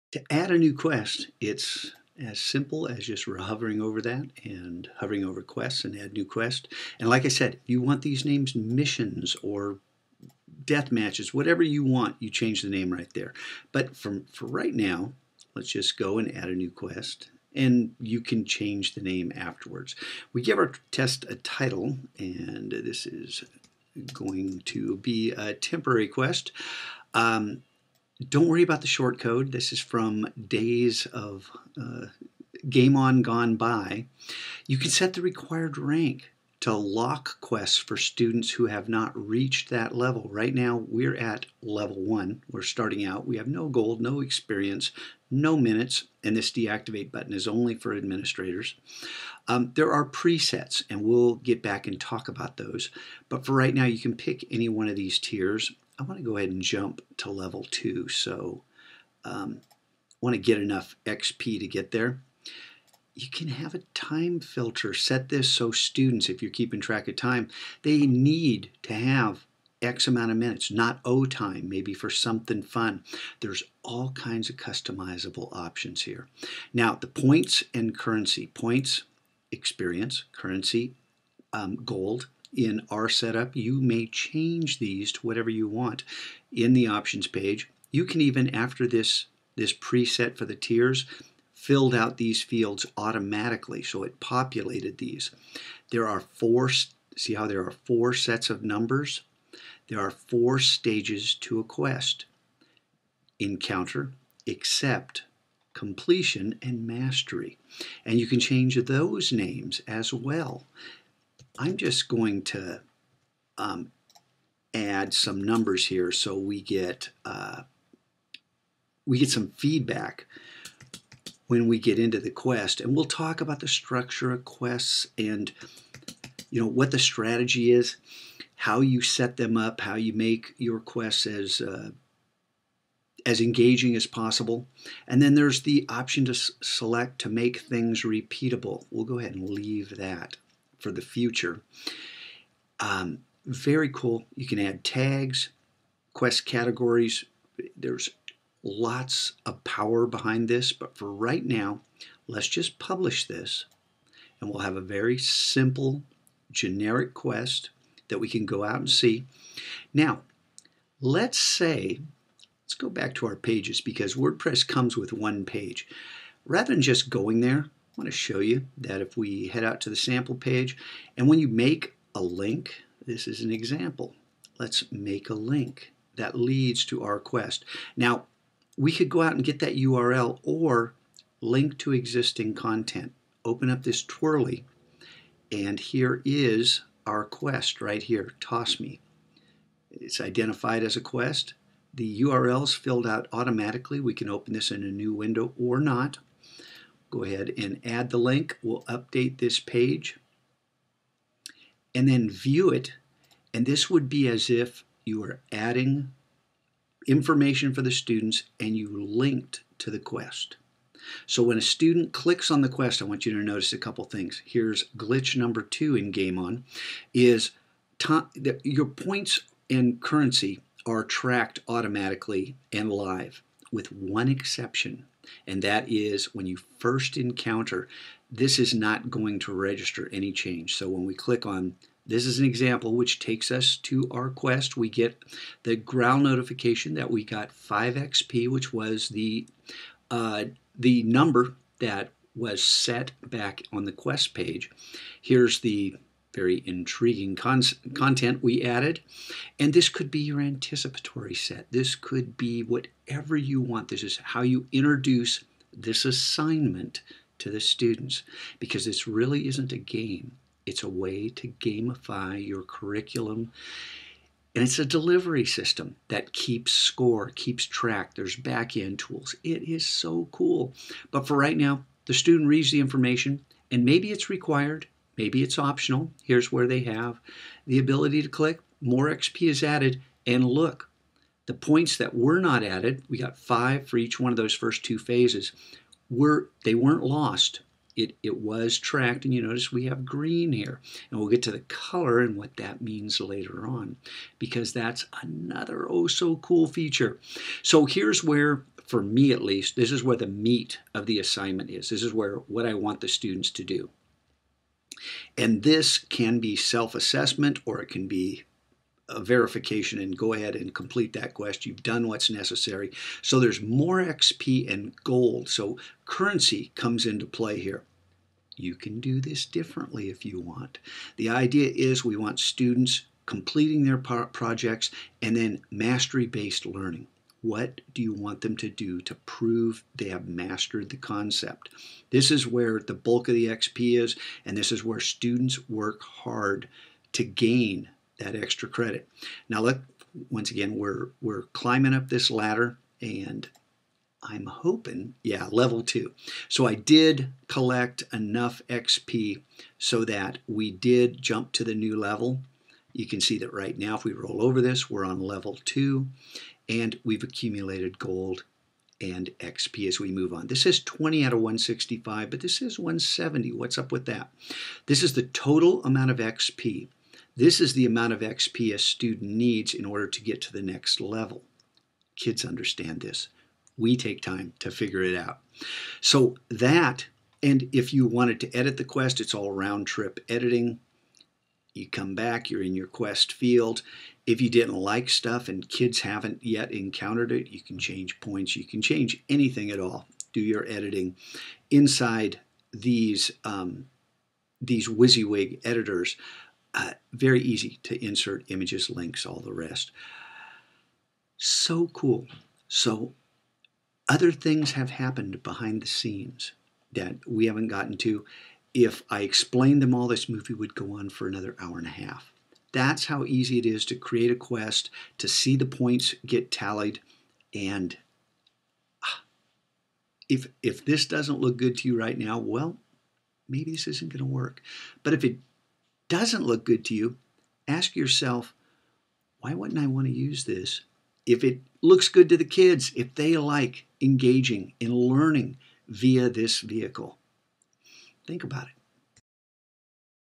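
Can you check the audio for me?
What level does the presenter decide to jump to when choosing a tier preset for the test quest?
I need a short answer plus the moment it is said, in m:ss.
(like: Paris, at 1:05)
Level 2, at 0:57.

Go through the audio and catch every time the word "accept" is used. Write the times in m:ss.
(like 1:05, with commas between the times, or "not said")
1:44.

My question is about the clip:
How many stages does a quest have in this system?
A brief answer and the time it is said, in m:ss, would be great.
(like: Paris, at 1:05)
4, at 1:40.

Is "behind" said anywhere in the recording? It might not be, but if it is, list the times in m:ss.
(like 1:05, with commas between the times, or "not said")
2:30, 6:45.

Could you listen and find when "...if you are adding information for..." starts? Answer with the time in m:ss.
3:24.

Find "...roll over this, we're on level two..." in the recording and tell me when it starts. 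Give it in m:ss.
5:54.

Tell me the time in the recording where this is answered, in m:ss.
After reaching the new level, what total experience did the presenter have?
6:02.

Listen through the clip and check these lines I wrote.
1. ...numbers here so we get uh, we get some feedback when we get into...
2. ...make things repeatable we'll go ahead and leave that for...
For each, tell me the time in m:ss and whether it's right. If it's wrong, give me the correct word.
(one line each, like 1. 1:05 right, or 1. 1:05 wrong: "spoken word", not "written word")
1. 1:55 right
2. 2:17 right.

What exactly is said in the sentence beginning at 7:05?
But if it doesn't look good to you, ask yourself, why wouldn't I want to use this?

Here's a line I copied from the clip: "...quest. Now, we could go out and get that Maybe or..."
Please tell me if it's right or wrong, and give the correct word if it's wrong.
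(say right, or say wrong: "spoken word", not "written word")
wrong: "URL", not "Maybe".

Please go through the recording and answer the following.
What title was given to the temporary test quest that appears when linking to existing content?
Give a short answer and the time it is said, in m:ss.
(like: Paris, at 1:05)
Toss Me, at 3:08.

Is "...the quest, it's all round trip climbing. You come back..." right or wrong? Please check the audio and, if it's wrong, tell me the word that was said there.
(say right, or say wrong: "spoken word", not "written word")
wrong: "editing", not "climbing".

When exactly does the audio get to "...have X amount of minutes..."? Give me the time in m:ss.
1:08.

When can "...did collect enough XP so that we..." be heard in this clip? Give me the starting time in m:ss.
5:46.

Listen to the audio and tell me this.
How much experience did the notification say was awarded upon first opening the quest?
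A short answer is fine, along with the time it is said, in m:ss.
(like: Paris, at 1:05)
5 XP, at 3:57.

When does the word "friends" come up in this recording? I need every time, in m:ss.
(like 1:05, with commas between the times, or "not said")
not said.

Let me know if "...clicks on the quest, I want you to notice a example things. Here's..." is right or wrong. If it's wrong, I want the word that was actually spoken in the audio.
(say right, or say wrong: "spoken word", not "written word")
wrong: "couple", not "example".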